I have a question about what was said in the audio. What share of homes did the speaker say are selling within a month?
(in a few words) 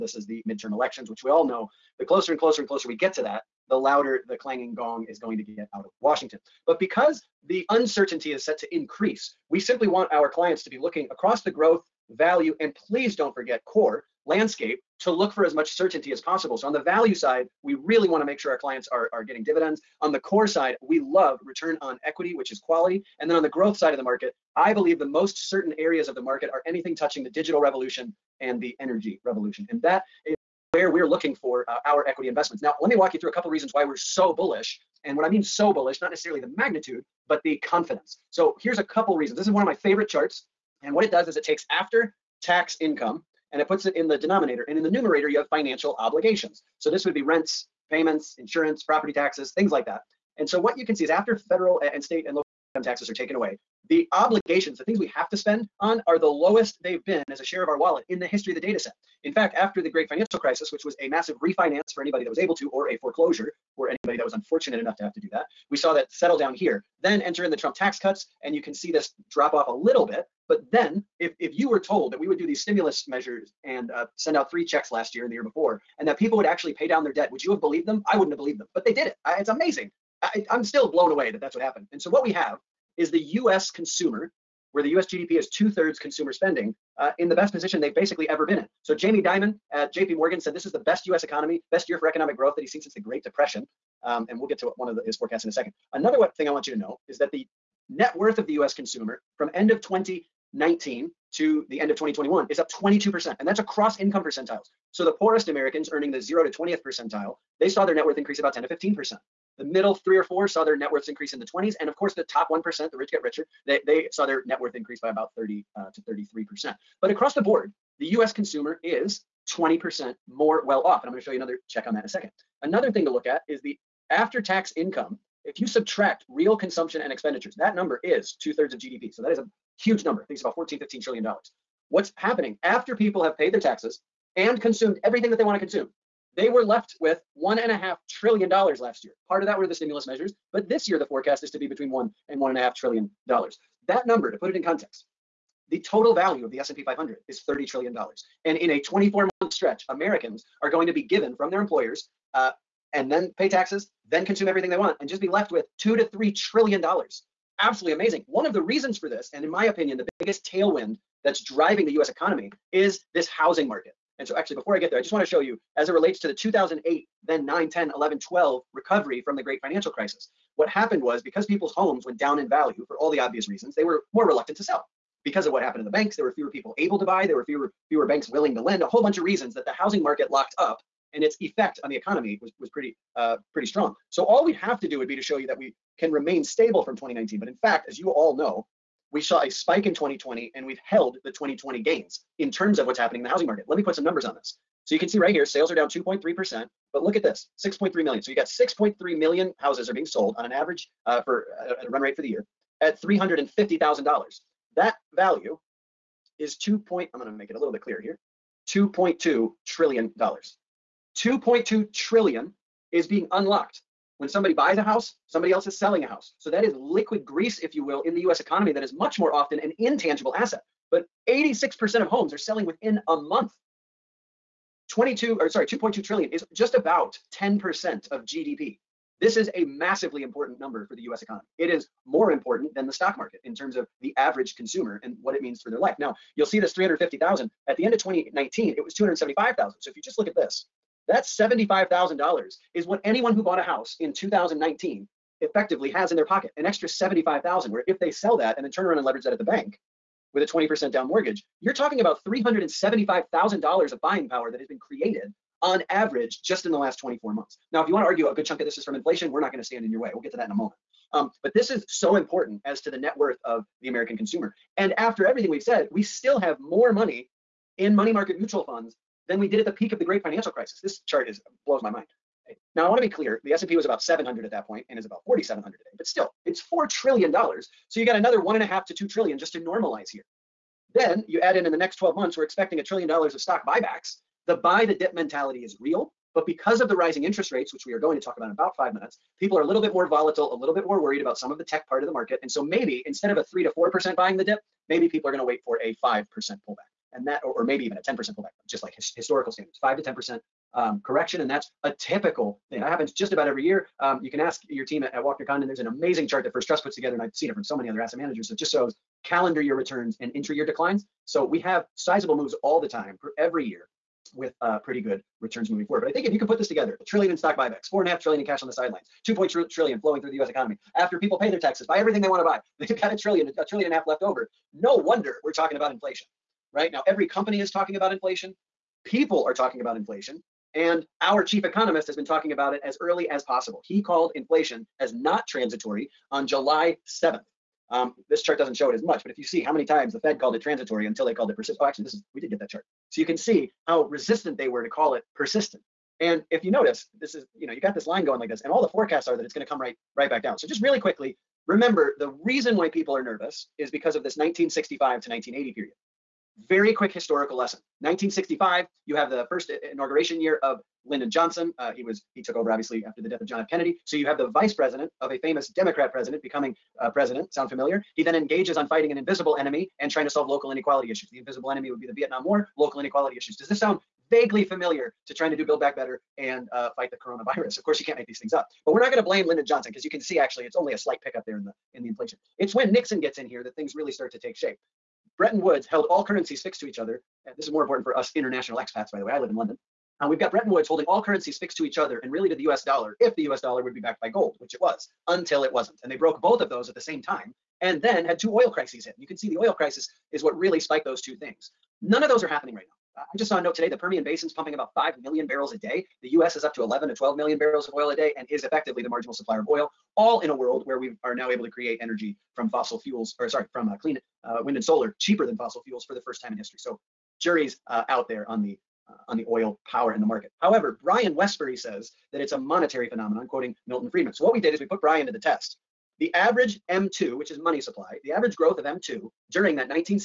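86%.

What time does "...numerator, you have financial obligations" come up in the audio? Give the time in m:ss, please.
0:44.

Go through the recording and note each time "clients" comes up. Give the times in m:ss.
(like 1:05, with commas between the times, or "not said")
0:10, 0:18.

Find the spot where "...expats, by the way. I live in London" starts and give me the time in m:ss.
6:28.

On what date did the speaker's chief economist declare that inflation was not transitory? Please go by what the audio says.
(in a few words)
July 7.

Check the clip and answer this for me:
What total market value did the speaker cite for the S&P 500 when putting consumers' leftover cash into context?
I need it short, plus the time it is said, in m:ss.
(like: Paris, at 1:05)
$30 trillion, at 2:27.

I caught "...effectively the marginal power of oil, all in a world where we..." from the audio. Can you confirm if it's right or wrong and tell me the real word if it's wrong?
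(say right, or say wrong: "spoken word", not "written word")
wrong: "supplier", not "power".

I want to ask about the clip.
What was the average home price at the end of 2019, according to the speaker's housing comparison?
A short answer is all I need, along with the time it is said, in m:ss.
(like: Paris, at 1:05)
$275,000, at 3:58.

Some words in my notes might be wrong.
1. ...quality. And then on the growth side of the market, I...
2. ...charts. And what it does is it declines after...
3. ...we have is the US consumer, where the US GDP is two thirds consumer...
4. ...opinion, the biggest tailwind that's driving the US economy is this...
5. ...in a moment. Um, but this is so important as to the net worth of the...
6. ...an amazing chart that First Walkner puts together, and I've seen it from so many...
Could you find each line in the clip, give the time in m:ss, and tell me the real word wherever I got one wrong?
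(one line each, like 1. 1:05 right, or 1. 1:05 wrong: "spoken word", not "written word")
1. 0:22 right
2. 0:40 wrong: "takes", not "declines"
3. 1:22 right
4. 2:39 right
5. 4:20 right
6. 5:05 wrong: "Trust", not "Walkner".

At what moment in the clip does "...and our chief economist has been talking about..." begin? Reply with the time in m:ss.
5:30.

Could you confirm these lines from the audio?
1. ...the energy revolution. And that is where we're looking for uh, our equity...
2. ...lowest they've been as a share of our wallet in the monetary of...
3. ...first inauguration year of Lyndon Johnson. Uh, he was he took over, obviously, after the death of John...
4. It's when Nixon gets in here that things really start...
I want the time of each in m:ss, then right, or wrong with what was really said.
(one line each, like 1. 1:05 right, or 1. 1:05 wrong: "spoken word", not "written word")
1. 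0:28 right
2. 0:56 wrong: "history", not "monetary"
3. 5:59 right
4. 6:22 right.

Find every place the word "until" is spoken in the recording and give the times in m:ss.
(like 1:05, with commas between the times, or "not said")
5:41, 6:35.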